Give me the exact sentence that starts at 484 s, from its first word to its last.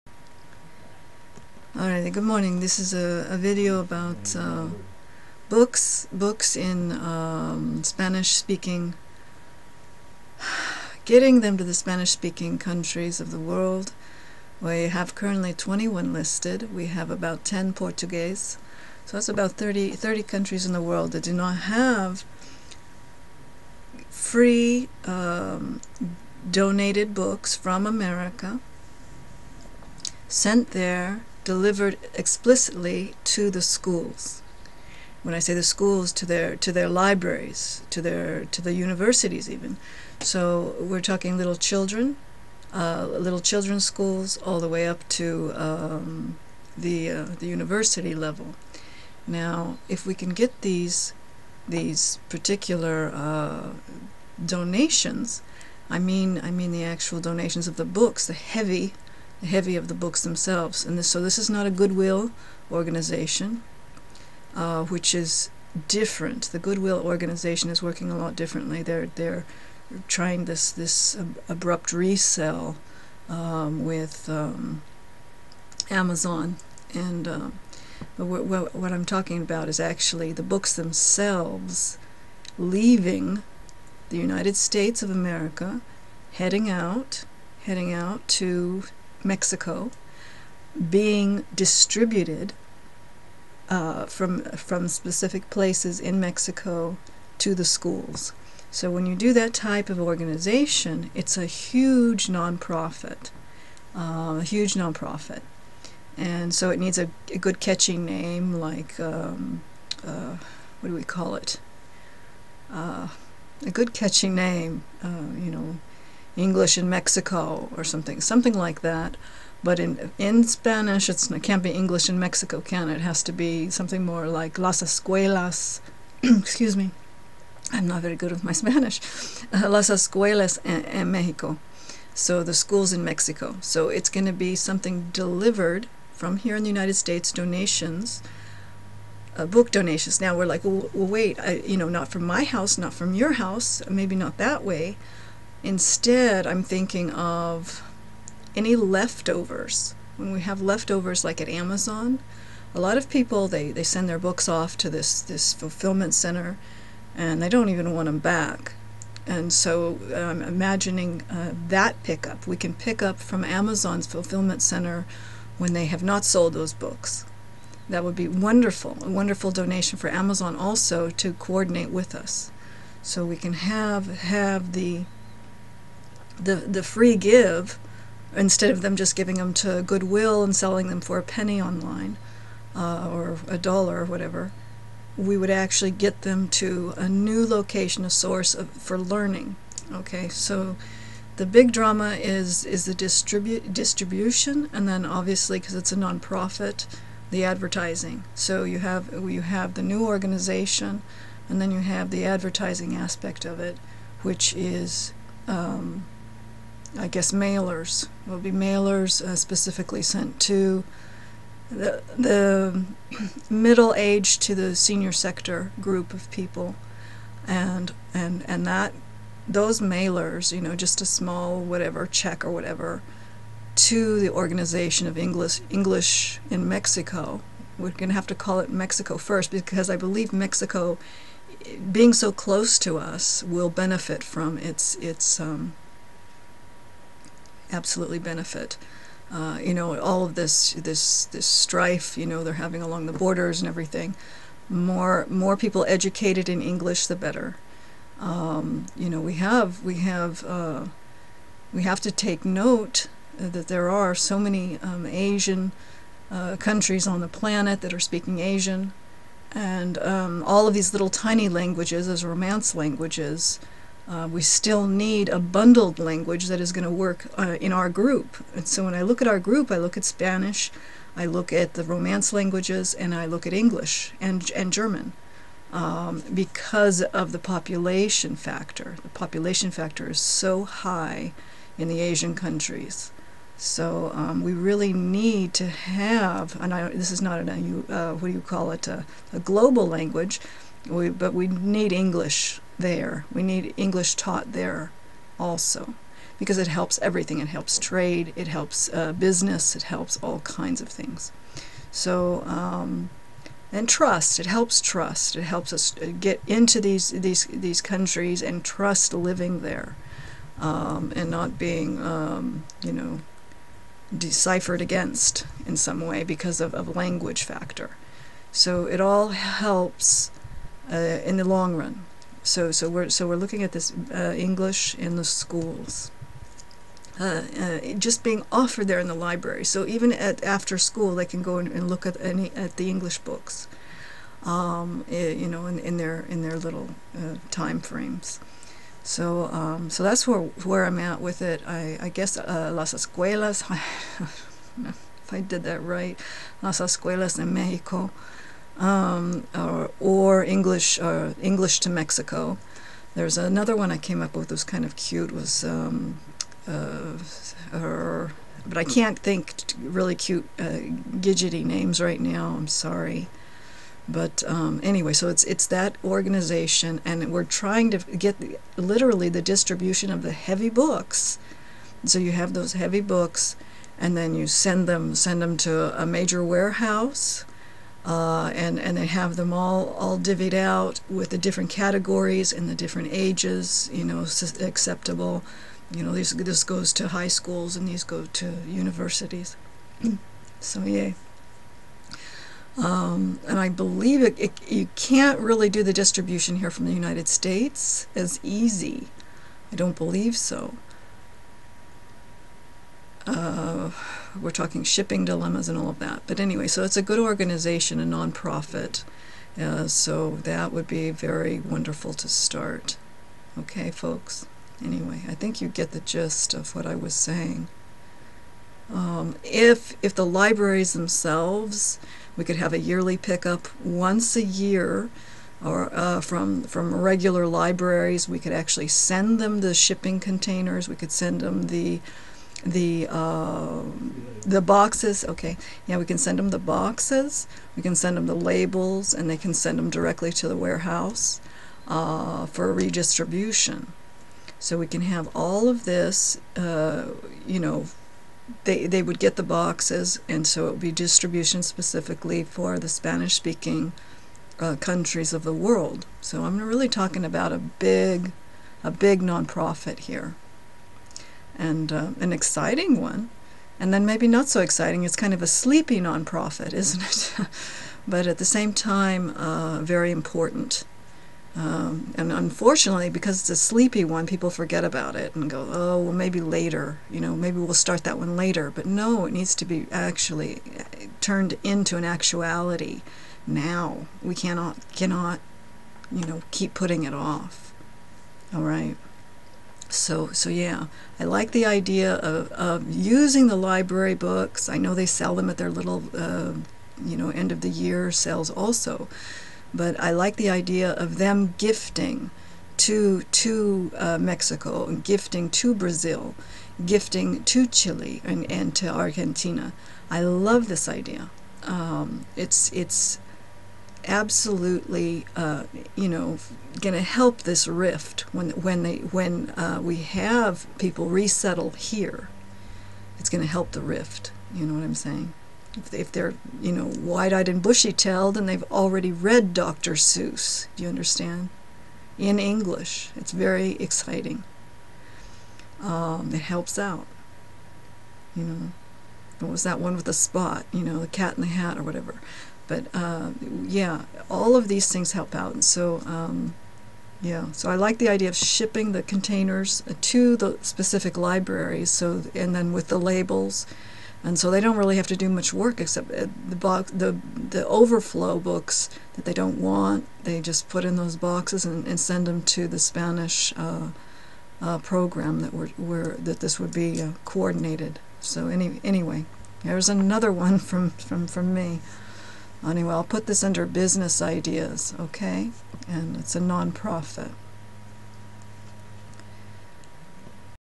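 We cannot, cannot, you know, keep putting it off.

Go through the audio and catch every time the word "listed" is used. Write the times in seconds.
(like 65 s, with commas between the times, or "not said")
16 s.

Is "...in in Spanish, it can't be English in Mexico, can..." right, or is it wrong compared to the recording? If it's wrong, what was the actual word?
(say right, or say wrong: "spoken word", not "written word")
right.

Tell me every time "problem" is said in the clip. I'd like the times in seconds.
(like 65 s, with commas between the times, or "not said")
not said.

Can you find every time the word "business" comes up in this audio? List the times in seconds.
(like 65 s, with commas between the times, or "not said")
299 s, 573 s.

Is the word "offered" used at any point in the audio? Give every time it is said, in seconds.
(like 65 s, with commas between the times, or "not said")
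328 s.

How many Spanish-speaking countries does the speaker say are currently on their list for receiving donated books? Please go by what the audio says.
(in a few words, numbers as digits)
21.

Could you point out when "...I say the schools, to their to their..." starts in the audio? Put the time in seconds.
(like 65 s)
35 s.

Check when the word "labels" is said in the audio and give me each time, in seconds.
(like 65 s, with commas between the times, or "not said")
438 s, 552 s.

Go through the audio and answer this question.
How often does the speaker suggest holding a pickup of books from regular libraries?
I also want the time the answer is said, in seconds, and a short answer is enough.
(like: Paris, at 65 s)
Once a year, at 423 s.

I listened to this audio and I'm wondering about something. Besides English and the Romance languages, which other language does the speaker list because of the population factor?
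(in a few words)
German.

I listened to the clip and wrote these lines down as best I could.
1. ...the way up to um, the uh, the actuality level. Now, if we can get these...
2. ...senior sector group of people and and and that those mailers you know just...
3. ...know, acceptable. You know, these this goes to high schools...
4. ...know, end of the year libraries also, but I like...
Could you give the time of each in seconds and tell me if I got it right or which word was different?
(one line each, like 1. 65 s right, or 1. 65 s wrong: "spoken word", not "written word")
1. 44 s wrong: "university", not "actuality"
2. 214 s right
3. 384 s right
4. 497 s wrong: "sales", not "libraries".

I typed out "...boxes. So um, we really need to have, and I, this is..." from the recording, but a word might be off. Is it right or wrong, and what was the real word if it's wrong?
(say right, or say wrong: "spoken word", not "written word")
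wrong: "countries", not "boxes".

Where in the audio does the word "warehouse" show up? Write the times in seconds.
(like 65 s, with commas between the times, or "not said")
376 s, 440 s.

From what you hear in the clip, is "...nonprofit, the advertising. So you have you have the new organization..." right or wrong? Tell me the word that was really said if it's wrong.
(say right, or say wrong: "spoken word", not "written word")
right.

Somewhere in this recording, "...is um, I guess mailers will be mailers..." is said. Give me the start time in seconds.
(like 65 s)
204 s.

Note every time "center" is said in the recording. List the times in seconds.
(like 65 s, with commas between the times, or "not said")
156 s, 164 s.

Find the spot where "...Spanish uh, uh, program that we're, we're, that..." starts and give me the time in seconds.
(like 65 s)
562 s.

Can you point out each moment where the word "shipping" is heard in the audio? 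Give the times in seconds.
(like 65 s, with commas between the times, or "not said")
404 s, 429 s, 548 s.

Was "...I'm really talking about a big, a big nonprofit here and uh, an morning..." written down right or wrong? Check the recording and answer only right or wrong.
wrong.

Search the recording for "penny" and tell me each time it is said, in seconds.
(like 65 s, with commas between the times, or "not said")
181 s.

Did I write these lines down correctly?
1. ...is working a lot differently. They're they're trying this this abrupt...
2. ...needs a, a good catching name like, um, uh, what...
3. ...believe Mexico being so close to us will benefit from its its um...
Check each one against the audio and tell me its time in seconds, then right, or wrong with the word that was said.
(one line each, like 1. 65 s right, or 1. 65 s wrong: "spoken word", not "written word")
1. 67 s right
2. 106 s right
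3. 229 s right.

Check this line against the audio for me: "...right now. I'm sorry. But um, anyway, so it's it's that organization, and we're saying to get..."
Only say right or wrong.
wrong.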